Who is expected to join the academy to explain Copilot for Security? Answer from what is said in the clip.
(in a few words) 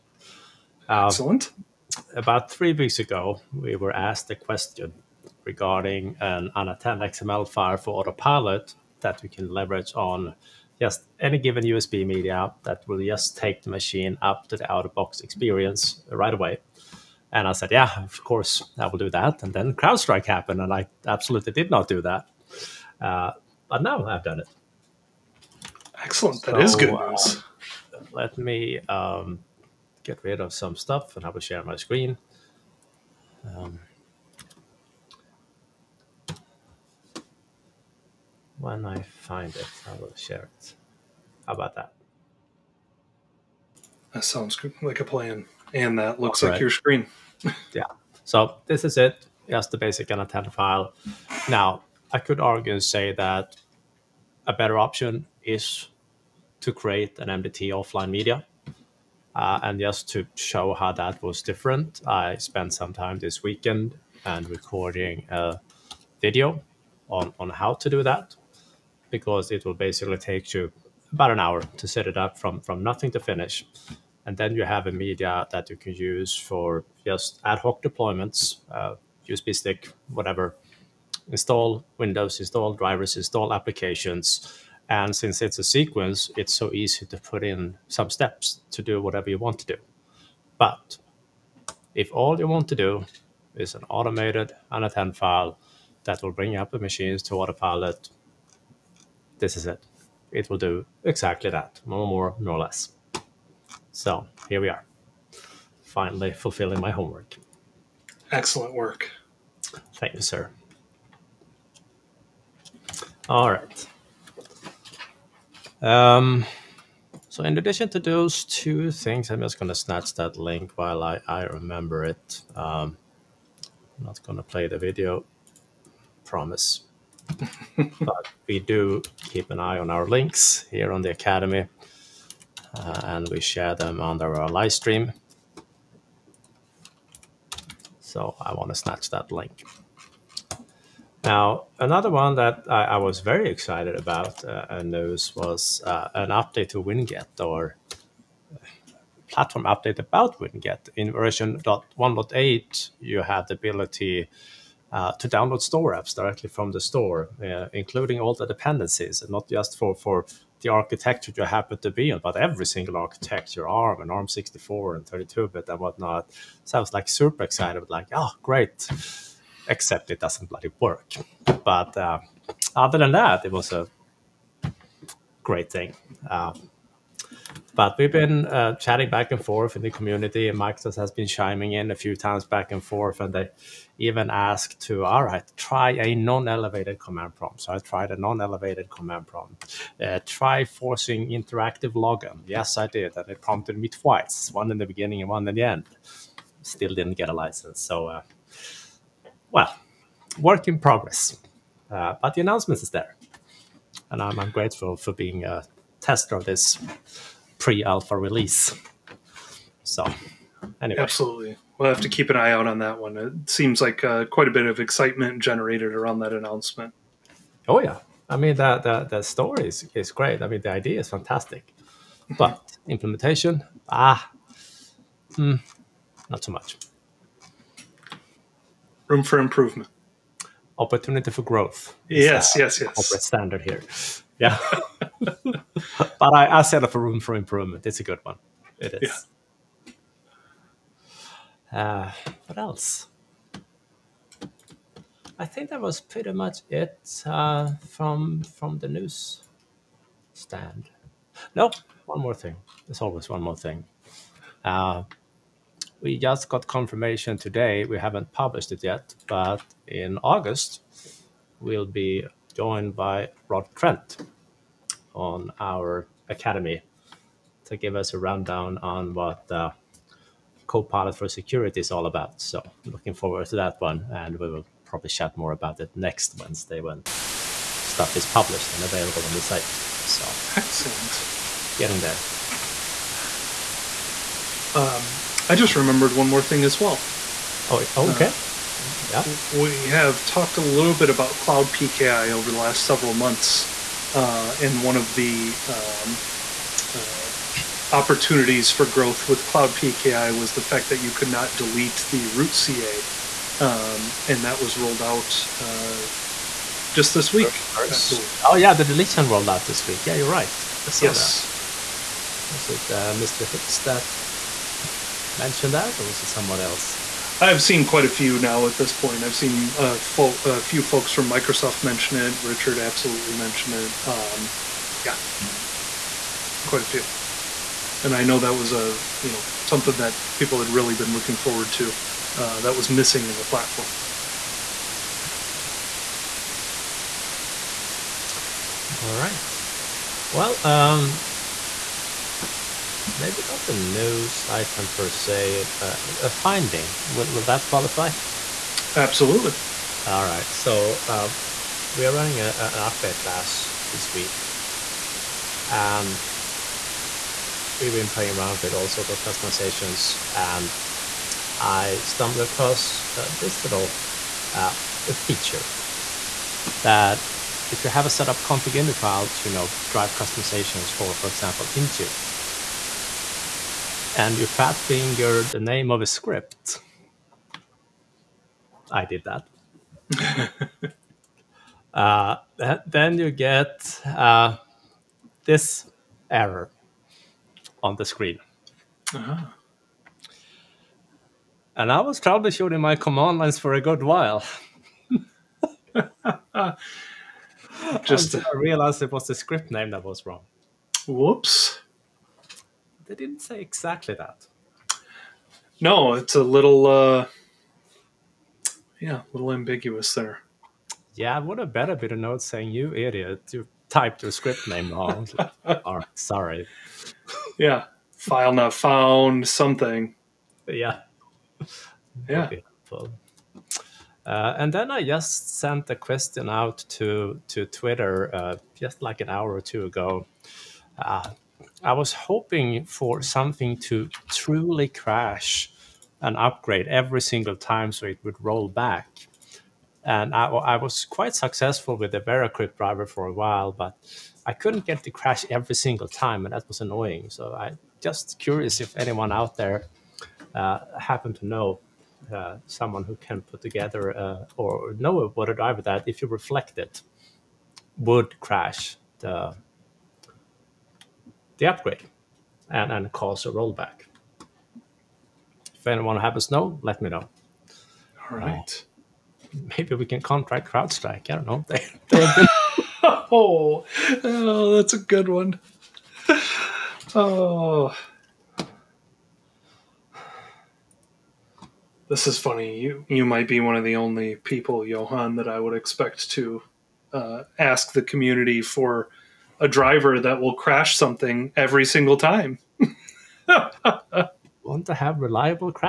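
Rod Trent.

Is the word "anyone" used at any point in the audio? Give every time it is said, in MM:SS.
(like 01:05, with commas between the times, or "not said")
07:28, 07:45.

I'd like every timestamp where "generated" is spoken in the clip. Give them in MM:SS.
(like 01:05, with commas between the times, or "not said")
03:35.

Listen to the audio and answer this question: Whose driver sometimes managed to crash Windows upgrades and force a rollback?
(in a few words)
VeraCrypt.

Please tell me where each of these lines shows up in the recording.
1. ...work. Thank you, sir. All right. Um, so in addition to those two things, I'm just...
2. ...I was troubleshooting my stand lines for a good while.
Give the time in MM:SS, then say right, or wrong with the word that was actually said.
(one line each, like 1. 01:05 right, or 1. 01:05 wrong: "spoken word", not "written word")
1. 01:48 right
2. 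06:31 wrong: "command", not "stand".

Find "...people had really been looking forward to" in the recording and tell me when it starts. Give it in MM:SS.
05:30.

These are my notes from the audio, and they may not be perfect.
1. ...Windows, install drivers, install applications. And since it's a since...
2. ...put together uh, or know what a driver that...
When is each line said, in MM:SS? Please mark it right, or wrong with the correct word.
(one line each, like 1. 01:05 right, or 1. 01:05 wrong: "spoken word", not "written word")
1. 01:21 wrong: "sequence", not "since"
2. 07:33 right.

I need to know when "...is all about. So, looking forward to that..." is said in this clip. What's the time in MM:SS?
04:31.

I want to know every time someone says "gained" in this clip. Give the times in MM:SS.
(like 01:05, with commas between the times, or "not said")
not said.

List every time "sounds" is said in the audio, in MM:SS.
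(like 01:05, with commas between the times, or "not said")
00:44, 02:46.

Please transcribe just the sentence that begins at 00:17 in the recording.
And I said, yeah, of course, I will do that.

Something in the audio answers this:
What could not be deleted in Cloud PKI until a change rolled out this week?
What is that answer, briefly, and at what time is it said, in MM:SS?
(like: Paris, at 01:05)
The root CA, at 05:02.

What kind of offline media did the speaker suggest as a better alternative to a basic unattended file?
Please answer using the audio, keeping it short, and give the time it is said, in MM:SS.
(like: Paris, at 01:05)
MDT offline media, at 00:57.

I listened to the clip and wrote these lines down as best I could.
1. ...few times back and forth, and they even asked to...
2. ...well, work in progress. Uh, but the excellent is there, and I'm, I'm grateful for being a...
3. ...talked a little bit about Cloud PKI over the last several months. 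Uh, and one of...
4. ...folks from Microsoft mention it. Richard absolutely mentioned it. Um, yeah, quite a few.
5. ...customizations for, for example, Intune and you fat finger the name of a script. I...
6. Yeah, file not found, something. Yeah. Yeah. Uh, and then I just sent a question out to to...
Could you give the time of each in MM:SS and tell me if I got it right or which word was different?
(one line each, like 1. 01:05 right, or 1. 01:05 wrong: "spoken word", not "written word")
1. 03:01 right
2. 03:19 wrong: "announcement", not "excellent"
3. 04:50 right
4. 05:20 right
5. 06:10 right
6. 06:57 right.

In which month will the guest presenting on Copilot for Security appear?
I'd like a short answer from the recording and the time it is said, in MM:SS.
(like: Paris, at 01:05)
August, at 04:20.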